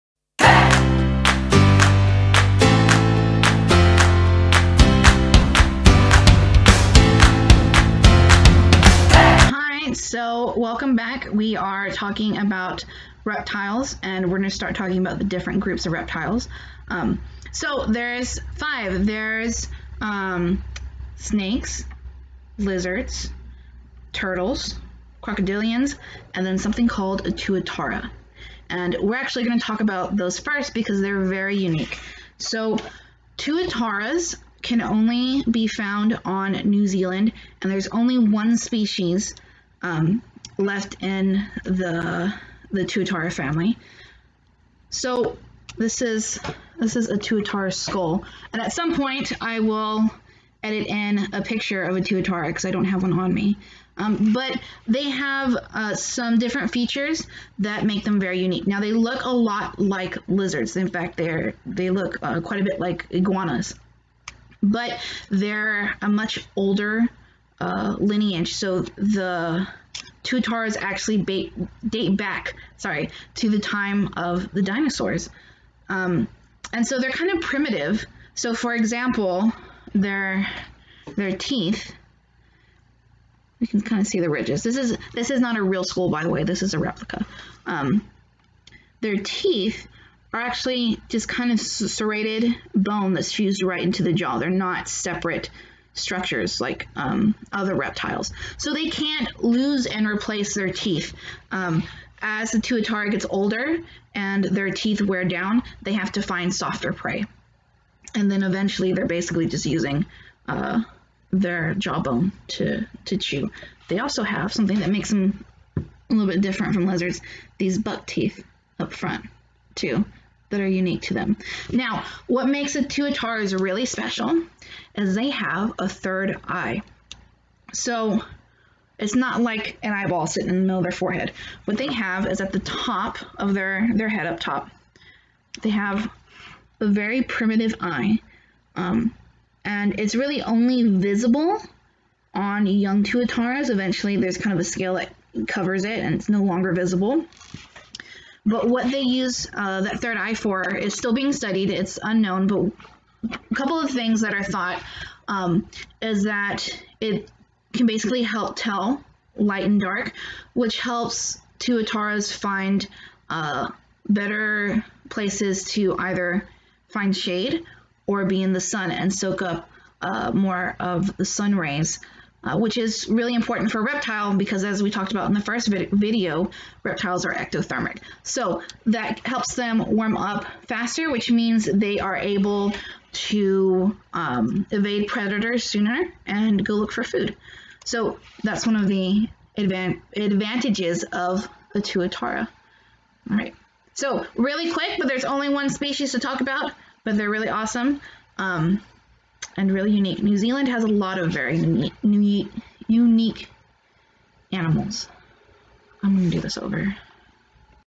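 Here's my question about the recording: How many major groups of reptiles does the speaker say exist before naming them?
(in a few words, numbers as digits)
5.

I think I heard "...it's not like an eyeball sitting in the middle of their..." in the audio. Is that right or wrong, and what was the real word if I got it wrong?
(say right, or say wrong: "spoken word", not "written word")
right.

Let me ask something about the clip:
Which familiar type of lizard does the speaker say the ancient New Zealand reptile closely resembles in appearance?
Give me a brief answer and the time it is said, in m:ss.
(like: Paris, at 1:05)
iguanas, at 1:03.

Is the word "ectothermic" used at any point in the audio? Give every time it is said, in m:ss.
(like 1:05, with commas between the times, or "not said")
2:57.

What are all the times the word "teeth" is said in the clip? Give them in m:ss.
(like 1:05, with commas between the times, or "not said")
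1:21, 1:29, 1:40, 1:44, 1:58.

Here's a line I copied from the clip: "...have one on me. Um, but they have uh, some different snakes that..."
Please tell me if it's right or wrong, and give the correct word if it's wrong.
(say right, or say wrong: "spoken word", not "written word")
wrong: "features", not "snakes".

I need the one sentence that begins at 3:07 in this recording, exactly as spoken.
So that's one of the advan advantages of the tuatara.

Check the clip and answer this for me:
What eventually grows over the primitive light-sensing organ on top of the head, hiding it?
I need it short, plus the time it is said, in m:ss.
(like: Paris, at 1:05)
a scale, at 2:24.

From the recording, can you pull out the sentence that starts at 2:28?
But what they use uh, that third eye for is still being studied.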